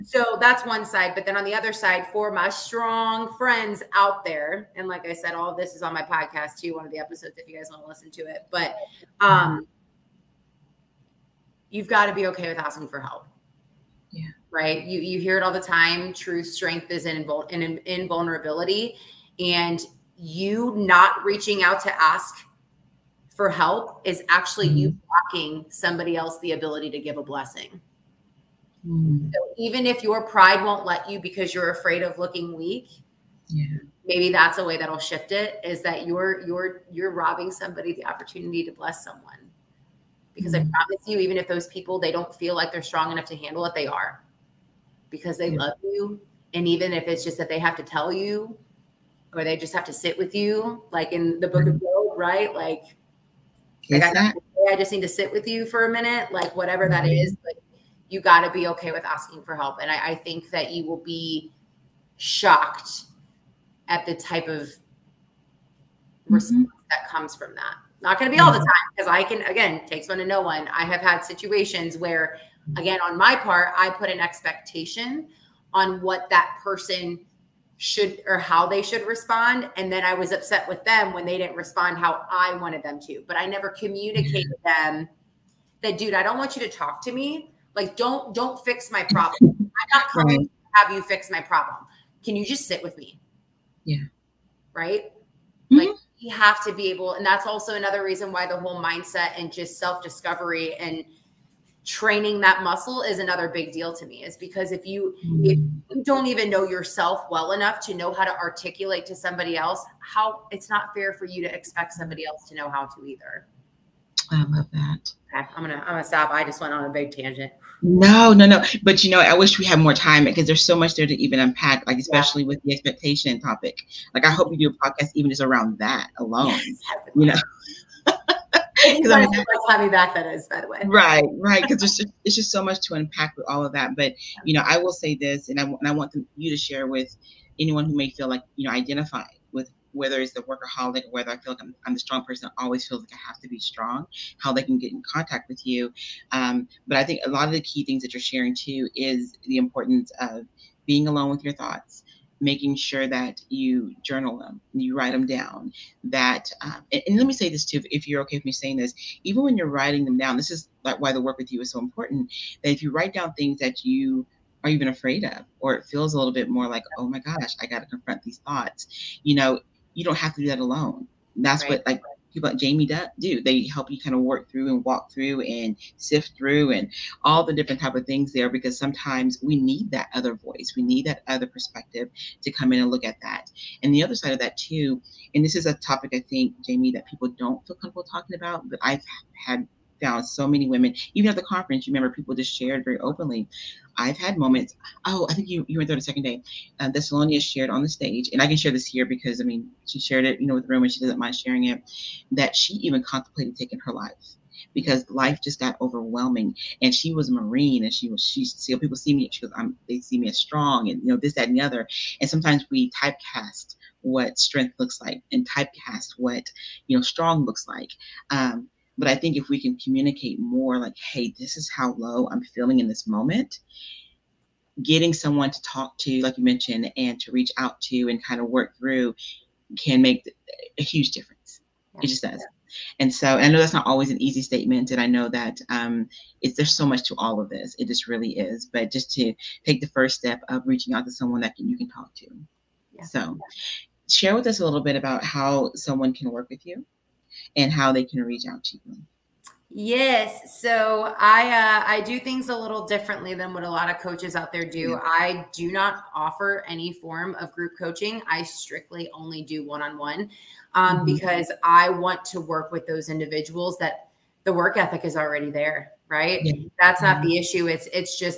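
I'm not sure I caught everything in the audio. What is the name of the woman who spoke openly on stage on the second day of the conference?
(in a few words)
Salonia.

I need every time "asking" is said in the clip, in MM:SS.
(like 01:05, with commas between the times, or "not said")
00:12, 00:59.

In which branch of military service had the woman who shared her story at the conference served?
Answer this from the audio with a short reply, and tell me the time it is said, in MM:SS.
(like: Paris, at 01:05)
Marine, at 03:27.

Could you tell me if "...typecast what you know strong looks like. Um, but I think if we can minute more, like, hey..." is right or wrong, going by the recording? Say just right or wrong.
wrong.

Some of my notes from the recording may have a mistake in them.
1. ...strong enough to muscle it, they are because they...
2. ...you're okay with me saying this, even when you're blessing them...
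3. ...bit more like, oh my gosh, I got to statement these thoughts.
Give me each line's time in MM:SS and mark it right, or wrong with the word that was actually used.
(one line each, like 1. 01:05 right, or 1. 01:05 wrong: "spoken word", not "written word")
1. 00:42 wrong: "handle", not "muscle"
2. 02:38 wrong: "writing", not "blessing"
3. 02:46 wrong: "confront", not "statement".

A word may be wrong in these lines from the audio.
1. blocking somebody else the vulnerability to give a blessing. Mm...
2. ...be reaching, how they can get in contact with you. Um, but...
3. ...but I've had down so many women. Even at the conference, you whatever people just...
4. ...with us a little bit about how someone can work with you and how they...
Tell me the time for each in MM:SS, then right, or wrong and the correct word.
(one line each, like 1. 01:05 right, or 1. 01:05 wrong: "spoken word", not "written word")
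1. 00:25 wrong: "ability", not "vulnerability"
2. 02:23 wrong: "strong", not "reaching"
3. 03:08 wrong: "remember", not "whatever"
4. 04:04 right.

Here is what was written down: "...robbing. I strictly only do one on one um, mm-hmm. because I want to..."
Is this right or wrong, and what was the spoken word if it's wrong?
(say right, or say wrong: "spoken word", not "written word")
wrong: "coaching", not "robbing".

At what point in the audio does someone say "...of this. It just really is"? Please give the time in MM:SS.
03:57.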